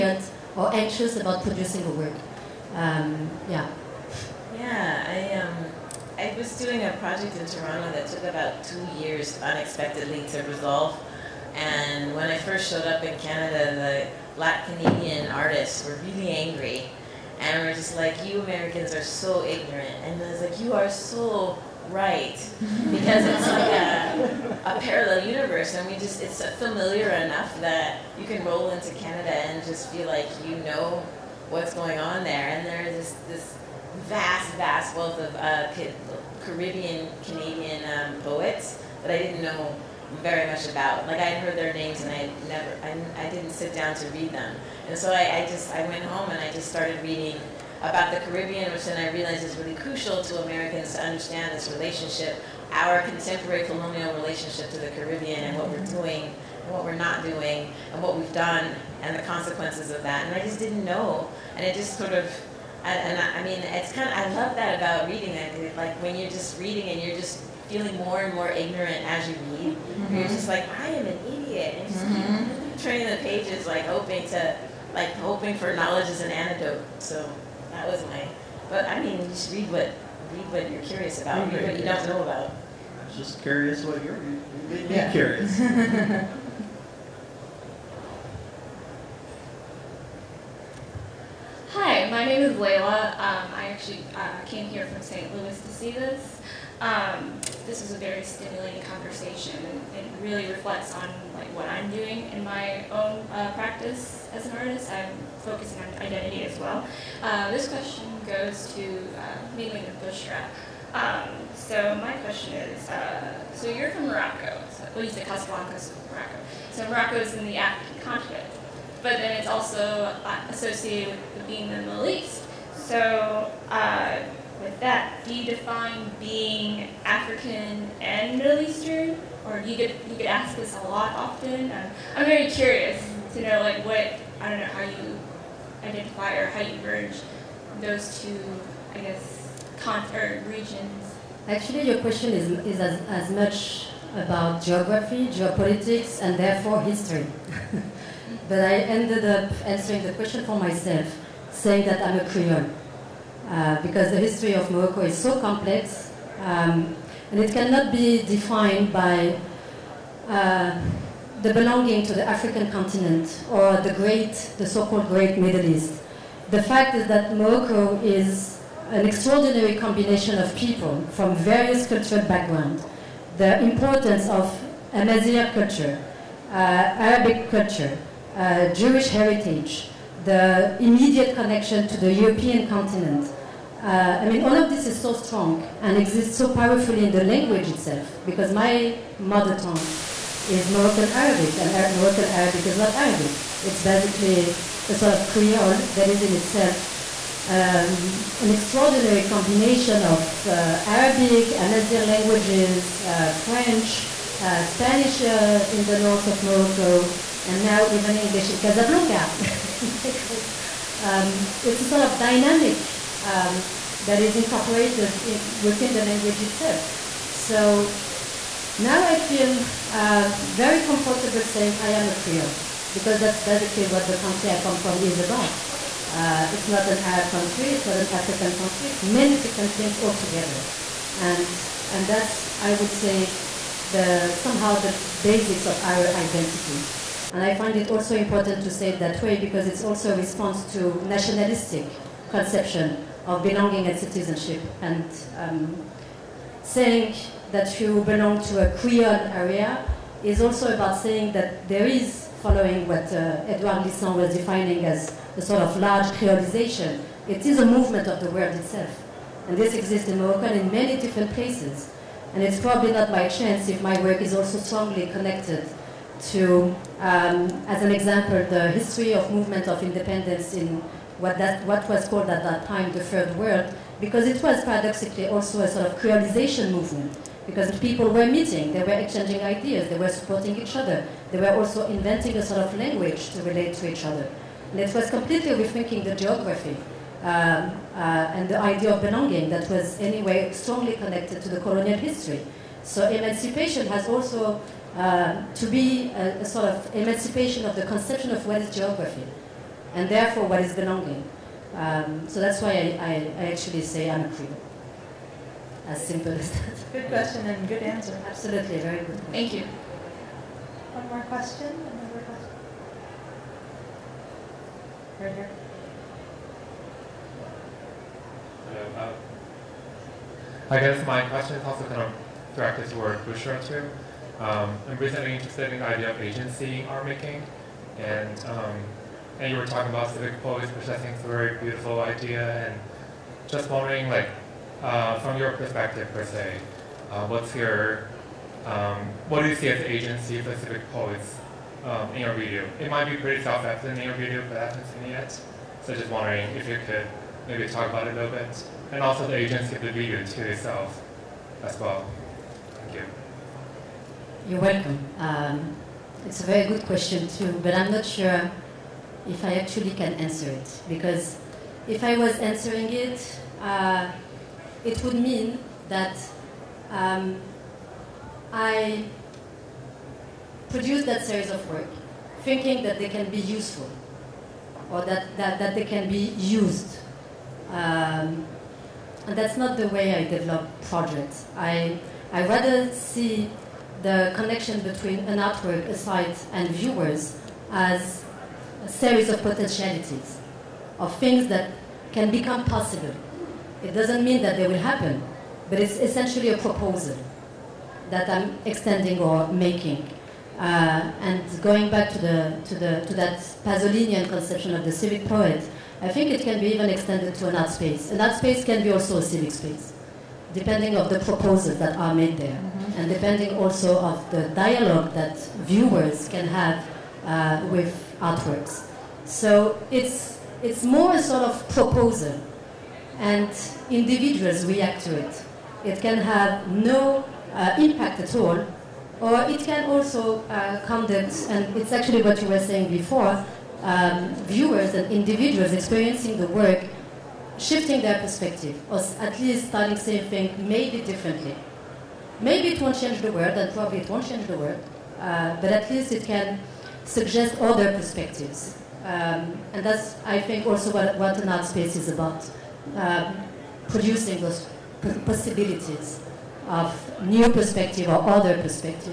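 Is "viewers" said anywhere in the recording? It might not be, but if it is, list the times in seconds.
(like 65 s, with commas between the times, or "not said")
386 s, 415 s, 434 s.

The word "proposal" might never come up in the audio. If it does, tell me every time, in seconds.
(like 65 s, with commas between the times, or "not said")
396 s, 411 s, 421 s.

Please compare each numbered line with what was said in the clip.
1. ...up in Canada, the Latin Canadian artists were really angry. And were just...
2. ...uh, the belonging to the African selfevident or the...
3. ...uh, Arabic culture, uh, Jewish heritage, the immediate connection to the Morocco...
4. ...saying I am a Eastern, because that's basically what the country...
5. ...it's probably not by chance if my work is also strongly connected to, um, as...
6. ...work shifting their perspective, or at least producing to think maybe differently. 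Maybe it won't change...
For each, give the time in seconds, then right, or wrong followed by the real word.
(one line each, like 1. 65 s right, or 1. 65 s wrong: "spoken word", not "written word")
1. 12 s right
2. 160 s wrong: "continent", not "selfevident"
3. 176 s wrong: "European", not "Morocco"
4. 221 s wrong: "Creole", not "Eastern"
5. 262 s right
6. 436 s wrong: "starting", not "producing".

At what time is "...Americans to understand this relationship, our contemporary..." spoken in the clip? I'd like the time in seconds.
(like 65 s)
50 s.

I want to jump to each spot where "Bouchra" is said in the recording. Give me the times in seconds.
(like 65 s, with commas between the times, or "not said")
110 s, 323 s.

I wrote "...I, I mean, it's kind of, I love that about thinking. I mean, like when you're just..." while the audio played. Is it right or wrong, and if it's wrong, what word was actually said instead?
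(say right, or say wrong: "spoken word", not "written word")
wrong: "reading", not "thinking".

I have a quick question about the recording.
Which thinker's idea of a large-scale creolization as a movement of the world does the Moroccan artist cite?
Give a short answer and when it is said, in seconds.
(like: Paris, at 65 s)
Edouard Glissant, at 253 s.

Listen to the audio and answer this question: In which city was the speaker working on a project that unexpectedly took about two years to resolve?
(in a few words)
Toronto.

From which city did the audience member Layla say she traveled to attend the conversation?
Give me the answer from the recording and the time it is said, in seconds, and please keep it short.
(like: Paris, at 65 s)
St. Louis, at 95 s.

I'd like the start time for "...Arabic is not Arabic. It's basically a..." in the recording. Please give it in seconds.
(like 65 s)
192 s.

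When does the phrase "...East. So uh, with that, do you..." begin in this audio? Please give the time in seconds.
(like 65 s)
122 s.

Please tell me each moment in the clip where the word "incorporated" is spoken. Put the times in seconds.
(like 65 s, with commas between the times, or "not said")
214 s.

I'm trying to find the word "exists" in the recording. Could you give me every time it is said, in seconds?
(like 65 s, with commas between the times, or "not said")
185 s, 259 s.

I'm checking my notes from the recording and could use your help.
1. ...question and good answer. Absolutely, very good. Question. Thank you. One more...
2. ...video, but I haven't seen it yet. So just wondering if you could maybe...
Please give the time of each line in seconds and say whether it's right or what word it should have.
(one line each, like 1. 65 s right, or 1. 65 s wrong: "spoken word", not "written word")
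1. 307 s right
2. 344 s right.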